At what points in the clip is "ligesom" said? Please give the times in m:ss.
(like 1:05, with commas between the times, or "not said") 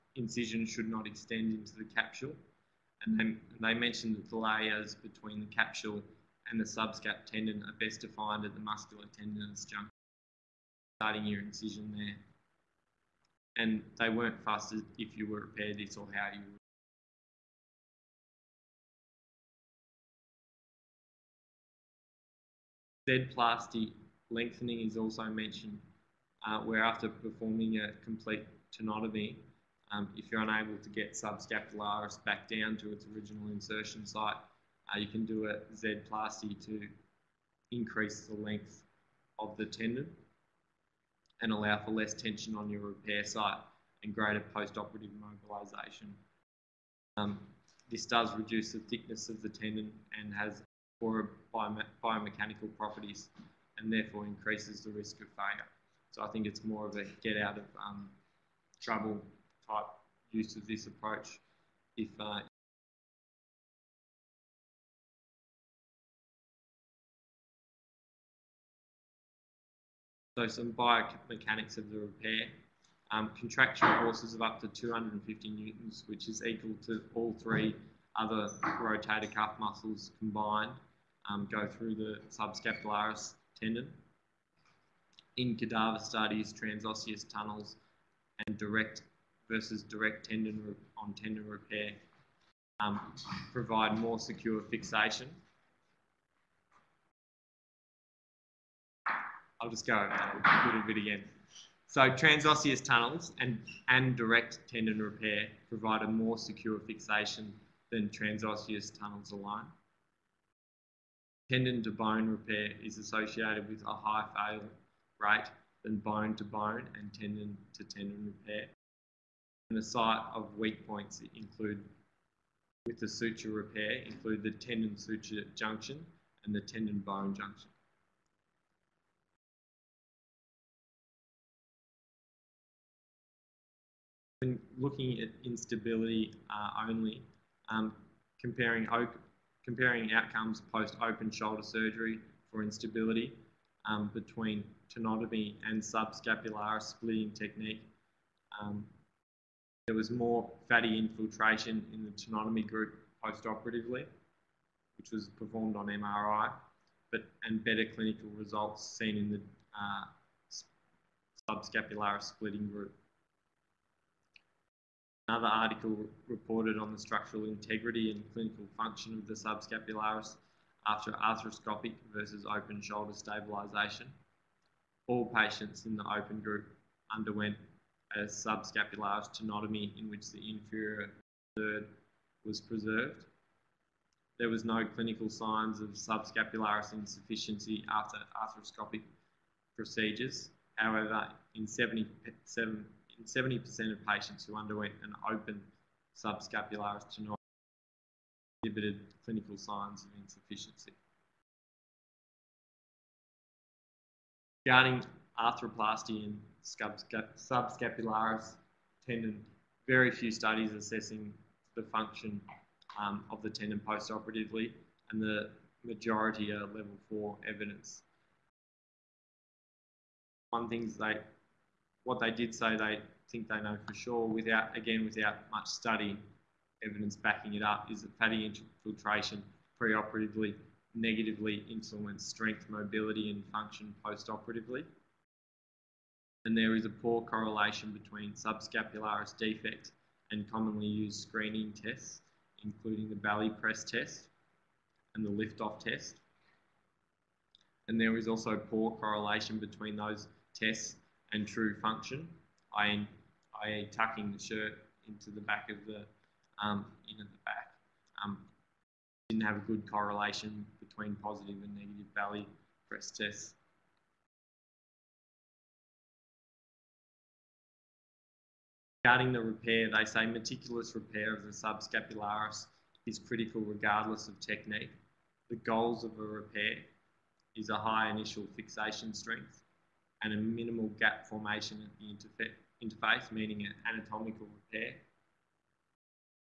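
not said.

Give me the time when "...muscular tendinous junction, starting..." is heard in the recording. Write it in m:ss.
0:08.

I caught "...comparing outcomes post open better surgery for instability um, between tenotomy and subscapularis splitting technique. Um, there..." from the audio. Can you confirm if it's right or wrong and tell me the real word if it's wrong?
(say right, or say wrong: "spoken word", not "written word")
wrong: "shoulder", not "better".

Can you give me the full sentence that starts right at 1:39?
I'll just go over that a little bit again.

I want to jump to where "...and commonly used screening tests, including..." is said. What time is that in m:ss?
4:00.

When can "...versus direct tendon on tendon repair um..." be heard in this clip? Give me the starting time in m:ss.
1:29.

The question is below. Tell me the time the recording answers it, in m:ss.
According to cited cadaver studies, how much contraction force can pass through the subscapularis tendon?
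1:14.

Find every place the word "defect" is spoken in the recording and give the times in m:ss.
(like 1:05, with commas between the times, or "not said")
3:59.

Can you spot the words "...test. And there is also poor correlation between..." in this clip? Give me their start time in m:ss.
4:05.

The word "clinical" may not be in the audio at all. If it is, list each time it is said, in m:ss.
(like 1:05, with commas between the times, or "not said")
2:37, 2:48, 3:04, 3:19.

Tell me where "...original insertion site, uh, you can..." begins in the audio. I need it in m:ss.
0:33.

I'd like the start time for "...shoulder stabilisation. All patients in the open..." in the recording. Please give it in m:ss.
2:52.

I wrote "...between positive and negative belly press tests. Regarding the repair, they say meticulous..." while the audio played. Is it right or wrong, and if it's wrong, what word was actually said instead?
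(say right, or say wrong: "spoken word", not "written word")
right.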